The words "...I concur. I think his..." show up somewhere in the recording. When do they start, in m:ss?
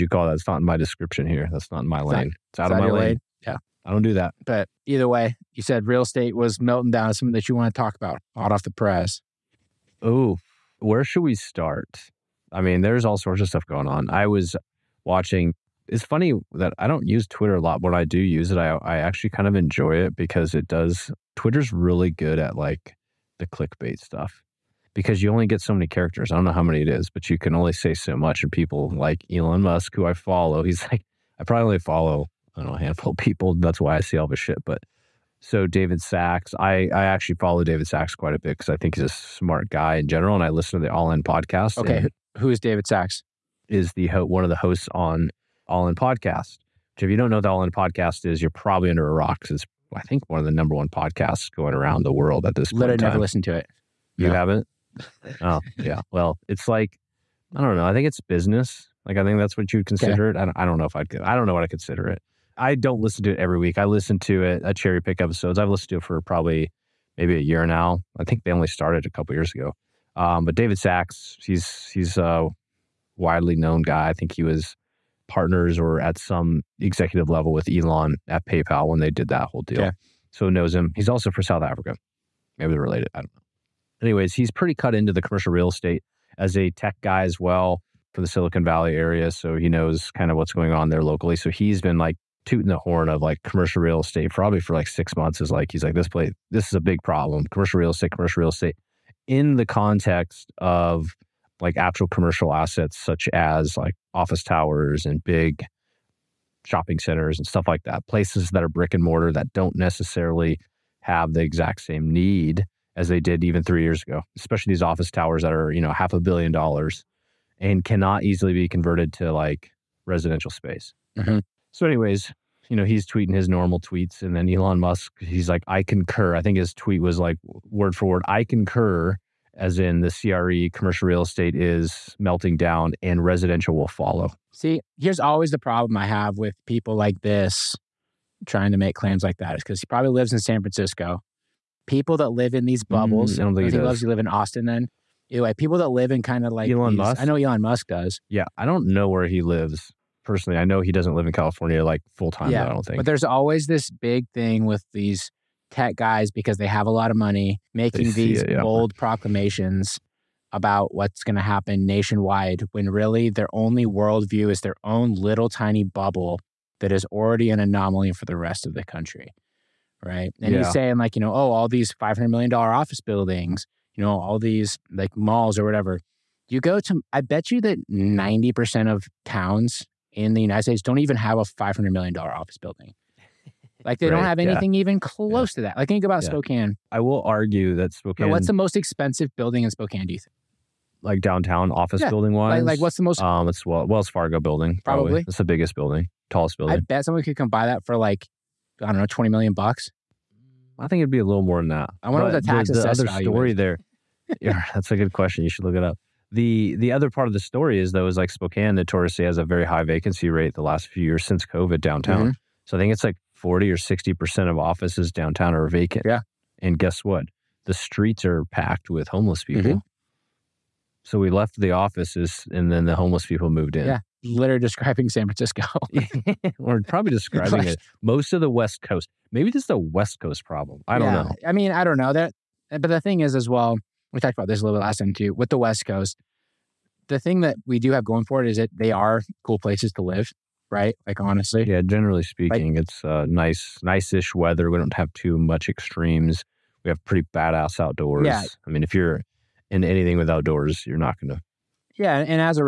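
2:05.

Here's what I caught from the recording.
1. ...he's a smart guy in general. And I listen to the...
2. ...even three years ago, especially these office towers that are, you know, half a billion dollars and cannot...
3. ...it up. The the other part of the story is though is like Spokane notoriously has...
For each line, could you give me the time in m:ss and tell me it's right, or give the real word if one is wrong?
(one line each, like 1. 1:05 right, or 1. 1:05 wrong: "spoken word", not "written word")
1. 0:38 right
2. 1:53 right
3. 3:25 right.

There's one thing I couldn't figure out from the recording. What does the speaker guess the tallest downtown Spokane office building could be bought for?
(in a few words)
$20 million.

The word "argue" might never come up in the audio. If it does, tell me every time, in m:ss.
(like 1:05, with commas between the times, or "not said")
3:07.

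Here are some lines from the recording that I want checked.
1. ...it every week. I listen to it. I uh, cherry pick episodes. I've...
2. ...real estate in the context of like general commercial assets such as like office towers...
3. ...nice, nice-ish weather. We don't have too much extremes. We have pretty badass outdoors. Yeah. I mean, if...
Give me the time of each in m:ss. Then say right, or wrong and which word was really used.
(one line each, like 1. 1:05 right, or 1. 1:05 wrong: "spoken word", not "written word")
1. 1:03 right
2. 1:38 wrong: "actual", not "general"
3. 4:03 right.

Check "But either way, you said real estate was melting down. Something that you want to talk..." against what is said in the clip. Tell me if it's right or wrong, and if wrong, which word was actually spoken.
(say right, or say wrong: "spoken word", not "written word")
right.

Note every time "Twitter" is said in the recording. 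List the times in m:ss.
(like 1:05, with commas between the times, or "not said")
0:17, 0:21.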